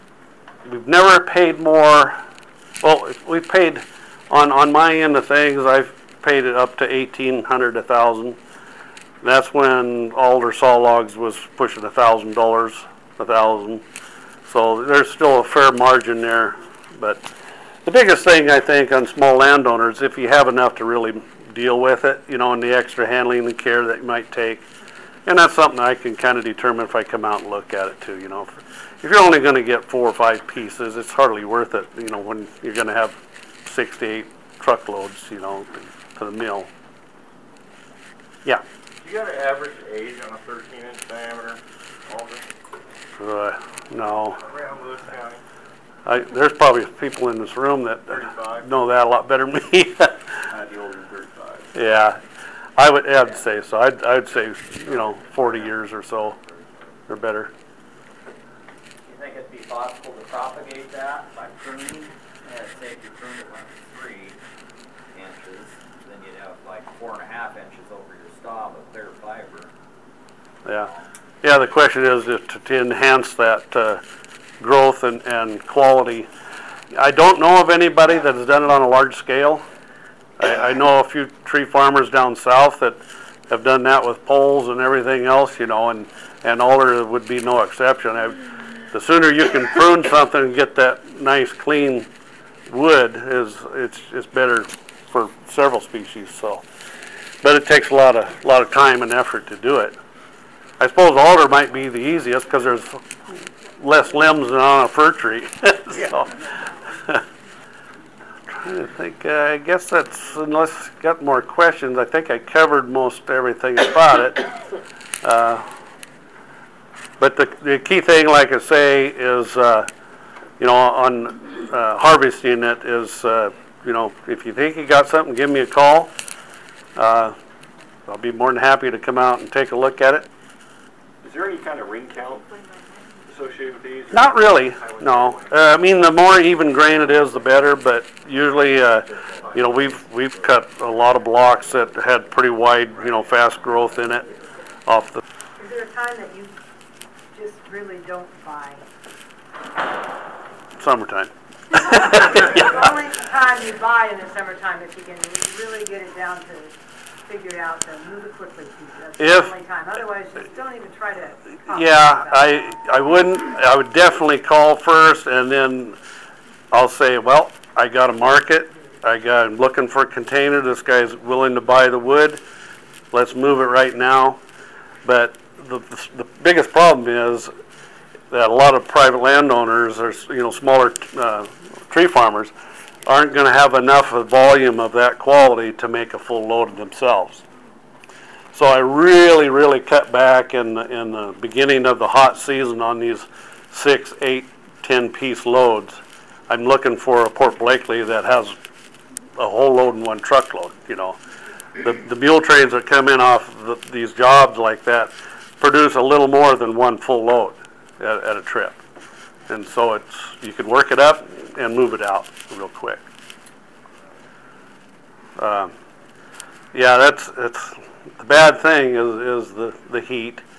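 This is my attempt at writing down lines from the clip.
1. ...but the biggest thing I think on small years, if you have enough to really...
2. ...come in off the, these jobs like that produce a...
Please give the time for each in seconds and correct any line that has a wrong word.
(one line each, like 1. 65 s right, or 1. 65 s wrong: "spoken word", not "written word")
1. 16 s wrong: "landowners", not "years"
2. 202 s right.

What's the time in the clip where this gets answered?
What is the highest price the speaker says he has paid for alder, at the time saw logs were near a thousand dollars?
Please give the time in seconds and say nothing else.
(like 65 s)
6 s.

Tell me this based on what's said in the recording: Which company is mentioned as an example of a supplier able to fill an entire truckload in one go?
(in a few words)
Port Blakely.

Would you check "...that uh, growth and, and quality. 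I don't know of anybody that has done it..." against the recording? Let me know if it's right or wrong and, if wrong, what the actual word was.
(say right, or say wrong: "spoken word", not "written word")
right.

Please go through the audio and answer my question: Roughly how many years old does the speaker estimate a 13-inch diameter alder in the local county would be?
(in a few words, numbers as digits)
40 years.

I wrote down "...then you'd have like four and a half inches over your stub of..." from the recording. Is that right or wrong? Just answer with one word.
right.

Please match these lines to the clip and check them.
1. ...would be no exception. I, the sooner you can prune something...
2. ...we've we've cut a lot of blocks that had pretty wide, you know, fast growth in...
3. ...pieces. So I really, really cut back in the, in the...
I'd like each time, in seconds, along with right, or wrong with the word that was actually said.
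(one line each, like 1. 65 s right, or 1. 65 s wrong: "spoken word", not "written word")
1. 87 s right
2. 139 s right
3. 186 s wrong: "themselves", not "pieces".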